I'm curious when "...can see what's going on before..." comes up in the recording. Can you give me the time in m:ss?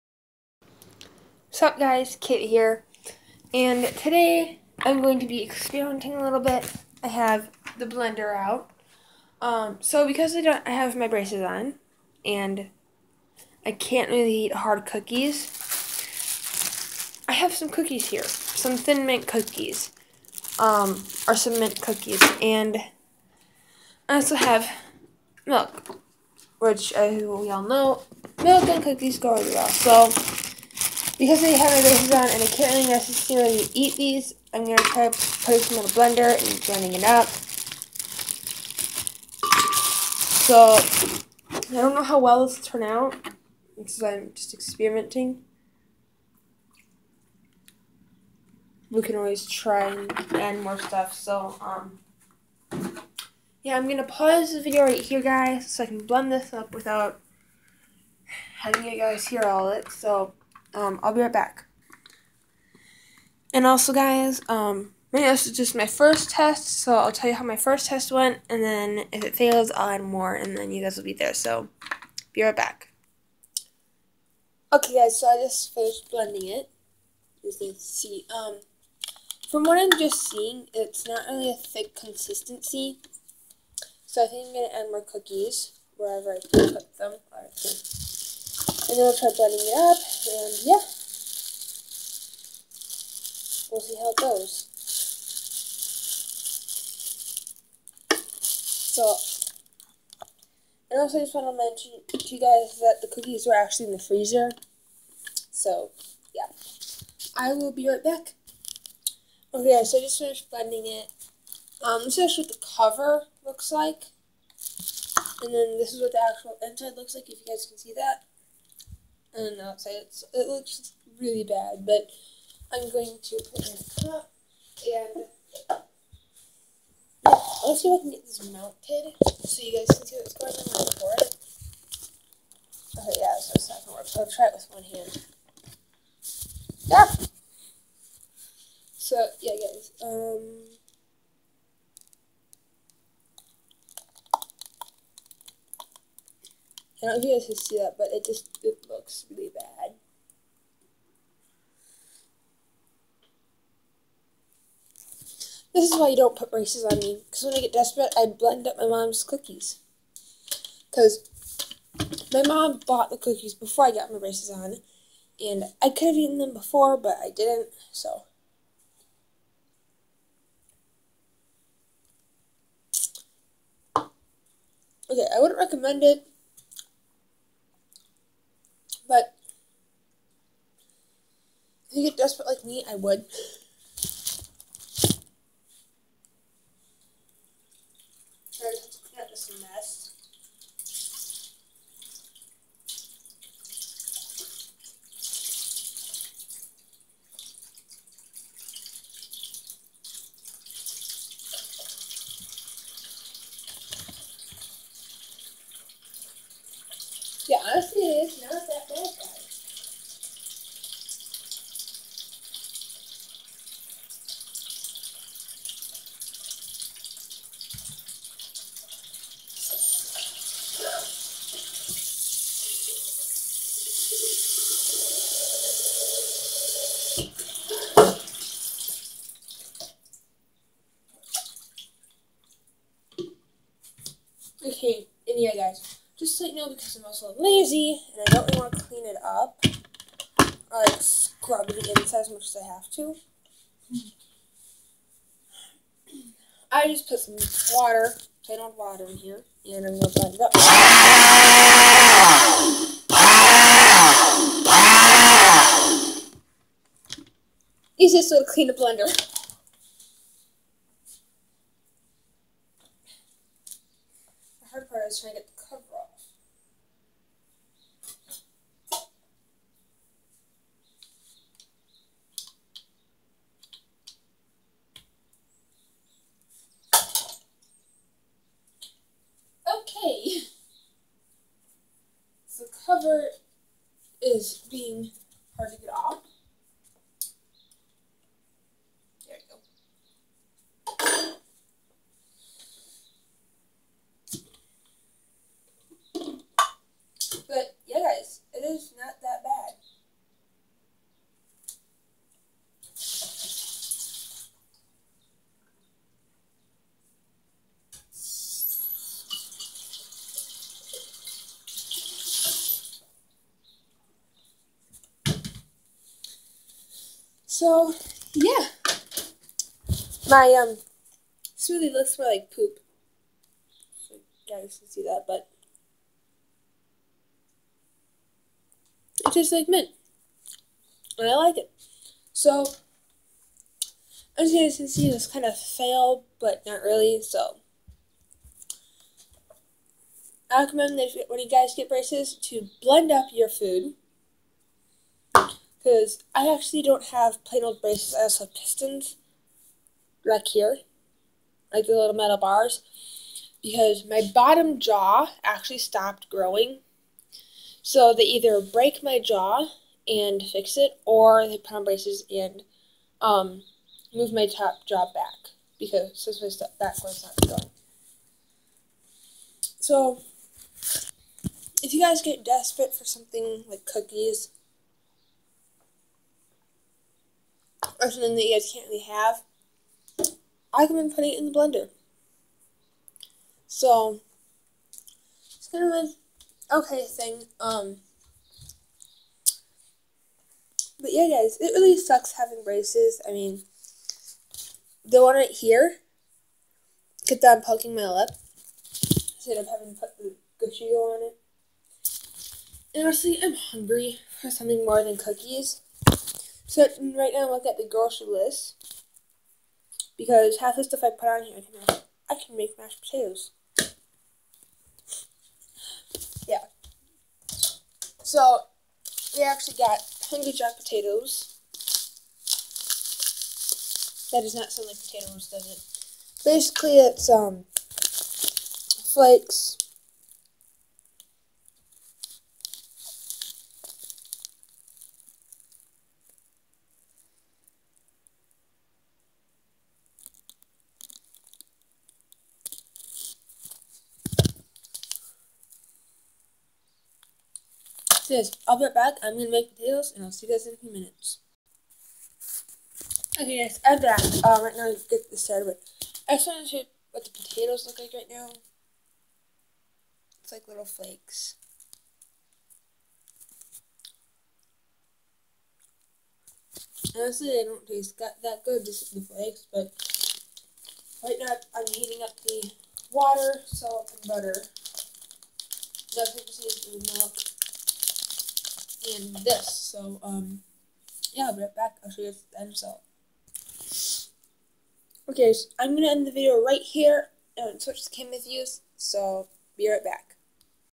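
2:09.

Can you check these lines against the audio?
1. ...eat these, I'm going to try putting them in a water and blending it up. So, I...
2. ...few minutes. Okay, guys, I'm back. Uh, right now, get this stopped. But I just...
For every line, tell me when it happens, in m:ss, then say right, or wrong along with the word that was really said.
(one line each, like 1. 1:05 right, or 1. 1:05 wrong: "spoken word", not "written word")
1. 0:33 wrong: "blender", not "water"
2. 7:30 wrong: "started", not "stopped".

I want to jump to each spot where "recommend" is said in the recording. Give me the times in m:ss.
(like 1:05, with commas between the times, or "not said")
2:55, 5:40, 6:20.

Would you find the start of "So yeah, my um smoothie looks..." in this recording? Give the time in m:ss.
5:17.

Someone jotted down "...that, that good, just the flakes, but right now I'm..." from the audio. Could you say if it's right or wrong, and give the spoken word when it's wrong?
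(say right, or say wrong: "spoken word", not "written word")
right.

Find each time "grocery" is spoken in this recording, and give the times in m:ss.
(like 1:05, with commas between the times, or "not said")
6:47.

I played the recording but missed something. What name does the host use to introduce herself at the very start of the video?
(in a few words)
Kit.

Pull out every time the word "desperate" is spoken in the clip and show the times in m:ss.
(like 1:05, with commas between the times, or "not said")
2:37, 3:02, 6:12.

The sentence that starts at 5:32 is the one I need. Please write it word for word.
So as you guys can see, this kind of fail, but not really.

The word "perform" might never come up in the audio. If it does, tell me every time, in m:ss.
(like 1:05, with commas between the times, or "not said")
not said.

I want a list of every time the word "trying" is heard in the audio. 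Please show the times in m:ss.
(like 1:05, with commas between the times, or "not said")
4:25.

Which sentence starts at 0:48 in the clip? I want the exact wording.
We can always try and add more stuff.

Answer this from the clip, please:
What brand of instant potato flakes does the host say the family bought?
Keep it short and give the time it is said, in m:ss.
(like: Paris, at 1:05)
Hungry Jack, at 7:00.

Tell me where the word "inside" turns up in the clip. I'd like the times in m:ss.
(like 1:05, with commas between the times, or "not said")
1:56, 4:01.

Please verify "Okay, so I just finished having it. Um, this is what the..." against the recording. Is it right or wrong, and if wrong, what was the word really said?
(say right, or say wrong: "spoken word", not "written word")
wrong: "blending", not "having".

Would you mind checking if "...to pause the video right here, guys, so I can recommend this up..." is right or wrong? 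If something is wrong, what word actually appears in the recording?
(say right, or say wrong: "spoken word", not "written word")
wrong: "blend", not "recommend".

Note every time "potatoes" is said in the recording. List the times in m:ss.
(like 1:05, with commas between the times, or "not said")
6:53, 7:00, 7:05, 7:29, 7:37.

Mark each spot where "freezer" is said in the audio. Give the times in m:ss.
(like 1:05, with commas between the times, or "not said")
1:43.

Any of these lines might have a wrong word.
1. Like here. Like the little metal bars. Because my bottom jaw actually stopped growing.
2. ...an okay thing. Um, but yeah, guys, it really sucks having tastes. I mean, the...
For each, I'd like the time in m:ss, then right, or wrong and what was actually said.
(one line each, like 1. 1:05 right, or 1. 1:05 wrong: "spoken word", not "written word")
1. 5:50 right
2. 6:25 wrong: "braces", not "tastes".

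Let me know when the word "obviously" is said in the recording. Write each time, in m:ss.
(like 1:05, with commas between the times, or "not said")
not said.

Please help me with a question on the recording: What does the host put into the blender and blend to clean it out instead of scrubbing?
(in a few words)
Plain old water.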